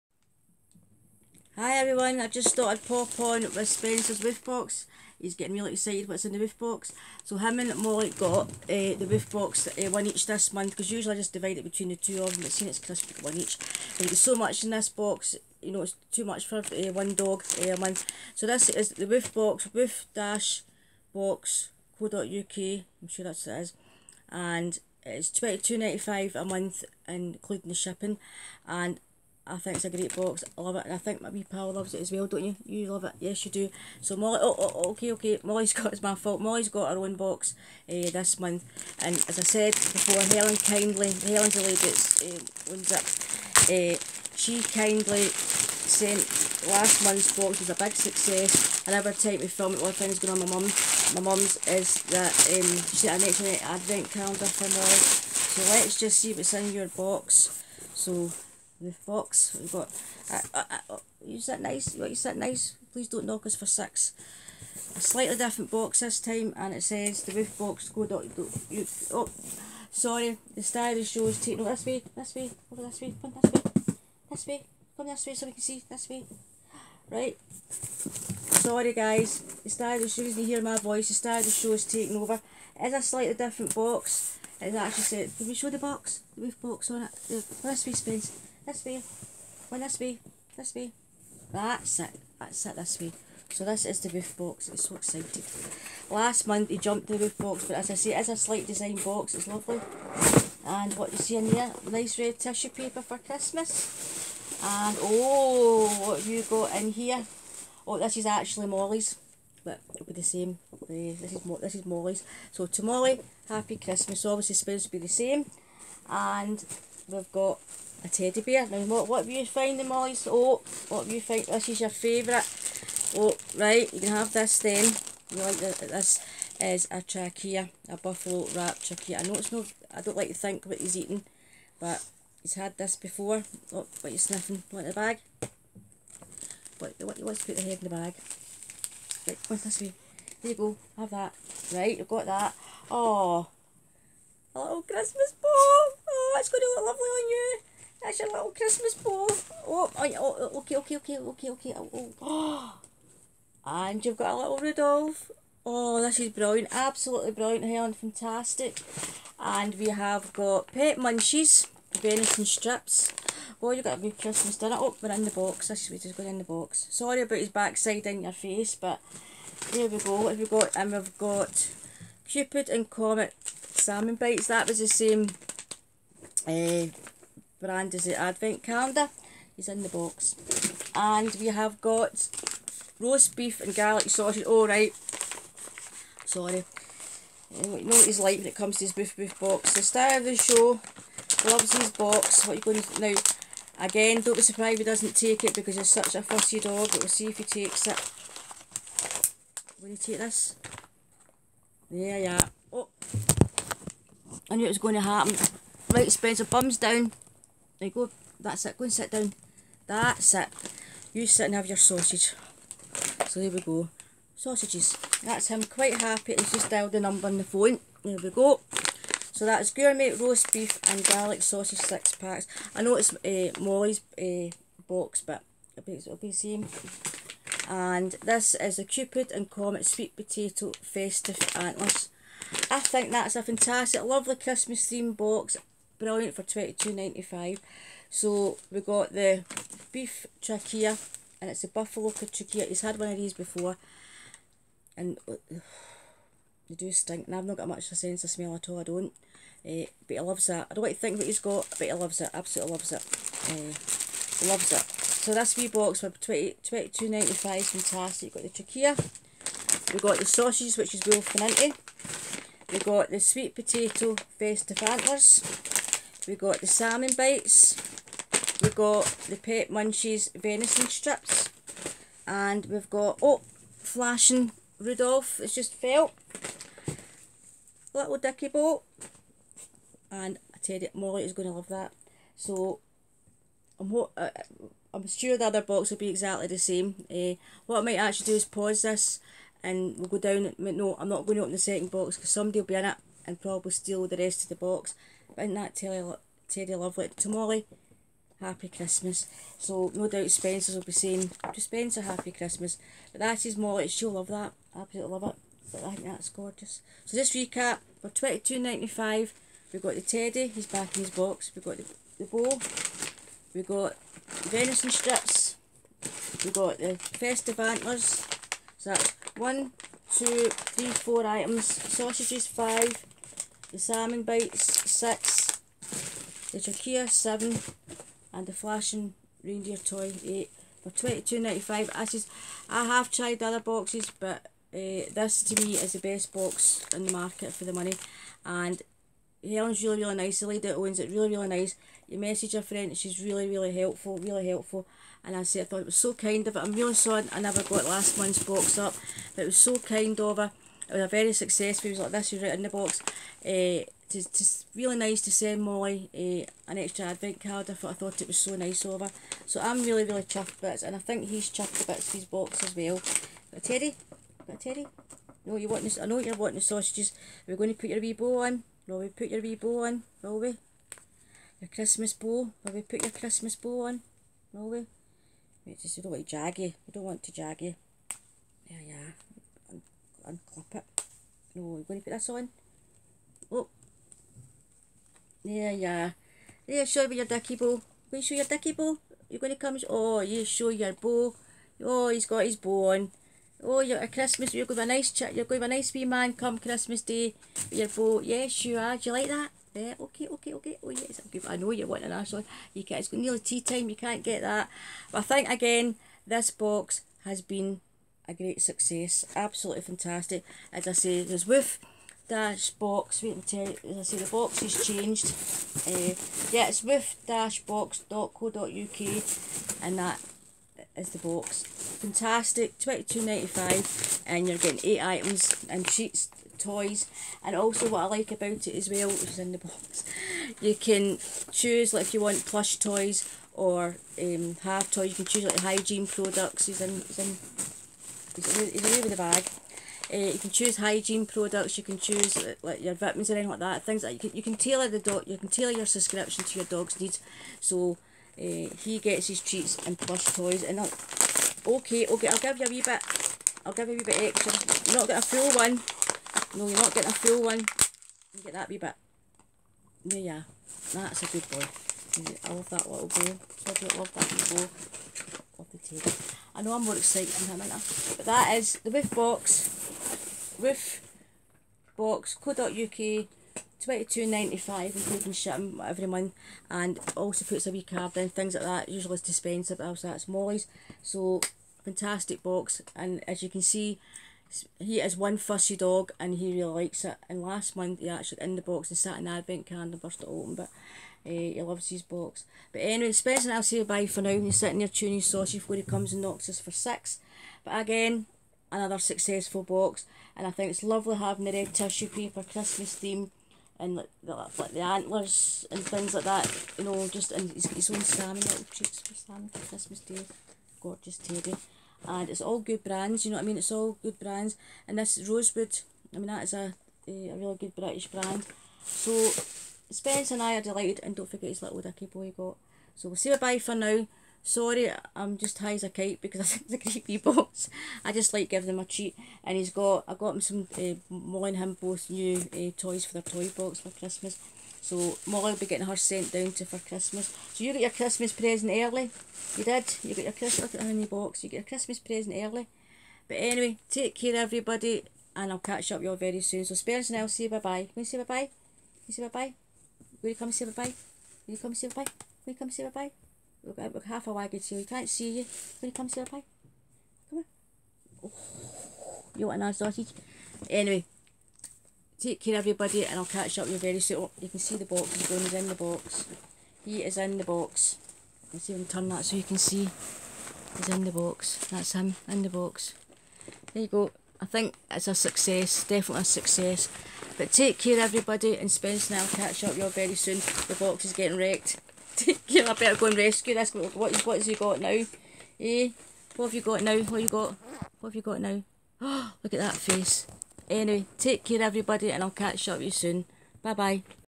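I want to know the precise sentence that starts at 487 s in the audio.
And last month he actually in the box and sat an advent calendar burst it open, but uh, he loves his box.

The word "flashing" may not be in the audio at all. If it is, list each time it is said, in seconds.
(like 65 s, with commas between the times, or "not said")
273 s, 328 s.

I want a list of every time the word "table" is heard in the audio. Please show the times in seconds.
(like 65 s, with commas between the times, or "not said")
465 s.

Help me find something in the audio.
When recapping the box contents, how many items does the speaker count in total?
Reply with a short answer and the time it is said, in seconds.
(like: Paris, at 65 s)
8, at 328 s.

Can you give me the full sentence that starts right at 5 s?
He's getting really excited what's in the Woof Box.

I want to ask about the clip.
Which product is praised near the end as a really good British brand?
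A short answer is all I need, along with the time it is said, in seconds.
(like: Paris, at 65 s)
Rosewood, at 514 s.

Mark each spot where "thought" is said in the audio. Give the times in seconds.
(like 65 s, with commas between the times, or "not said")
2 s, 345 s, 357 s.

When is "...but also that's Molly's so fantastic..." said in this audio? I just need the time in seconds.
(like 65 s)
479 s.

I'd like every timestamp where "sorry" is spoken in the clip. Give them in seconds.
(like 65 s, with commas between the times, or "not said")
69 s, 77 s, 166 s, 186 s, 346 s, 524 s.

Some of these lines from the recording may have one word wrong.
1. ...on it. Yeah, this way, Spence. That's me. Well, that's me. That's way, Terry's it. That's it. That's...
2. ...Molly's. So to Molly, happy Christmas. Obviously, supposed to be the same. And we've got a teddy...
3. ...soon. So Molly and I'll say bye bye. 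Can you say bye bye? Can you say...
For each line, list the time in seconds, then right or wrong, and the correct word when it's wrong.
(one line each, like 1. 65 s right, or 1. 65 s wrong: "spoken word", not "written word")
1. 86 s wrong: "That", not "Terry"
2. 111 s right
3. 546 s wrong: "Spence", not "Molly".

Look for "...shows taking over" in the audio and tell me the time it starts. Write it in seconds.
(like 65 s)
81 s.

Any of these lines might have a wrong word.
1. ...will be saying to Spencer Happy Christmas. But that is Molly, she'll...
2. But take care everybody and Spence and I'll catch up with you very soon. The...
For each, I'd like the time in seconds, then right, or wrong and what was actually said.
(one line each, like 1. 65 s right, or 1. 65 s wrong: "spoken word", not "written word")
1. 300 s right
2. 577 s right.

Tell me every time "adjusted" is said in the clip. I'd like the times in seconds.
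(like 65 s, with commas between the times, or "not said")
not said.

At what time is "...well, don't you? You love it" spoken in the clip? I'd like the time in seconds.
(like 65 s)
32 s.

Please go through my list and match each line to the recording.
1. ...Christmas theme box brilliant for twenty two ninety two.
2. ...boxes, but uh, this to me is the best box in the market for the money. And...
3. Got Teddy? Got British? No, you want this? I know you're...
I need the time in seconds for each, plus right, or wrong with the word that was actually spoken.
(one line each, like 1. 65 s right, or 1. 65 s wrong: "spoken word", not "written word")
1. 234 s wrong: "five", not "two"
2. 333 s right
3. 363 s wrong: "Teddy", not "British".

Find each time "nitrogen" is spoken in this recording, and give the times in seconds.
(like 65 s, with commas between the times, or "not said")
not said.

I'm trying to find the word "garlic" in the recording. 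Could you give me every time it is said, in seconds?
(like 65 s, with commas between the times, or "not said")
183 s, 221 s.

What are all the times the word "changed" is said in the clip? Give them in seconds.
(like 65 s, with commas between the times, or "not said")
414 s.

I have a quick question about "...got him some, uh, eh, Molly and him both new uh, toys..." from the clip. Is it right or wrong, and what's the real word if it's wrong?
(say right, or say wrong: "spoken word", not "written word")
right.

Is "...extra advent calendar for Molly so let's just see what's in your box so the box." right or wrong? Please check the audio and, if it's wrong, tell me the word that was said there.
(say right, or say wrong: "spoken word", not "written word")
right.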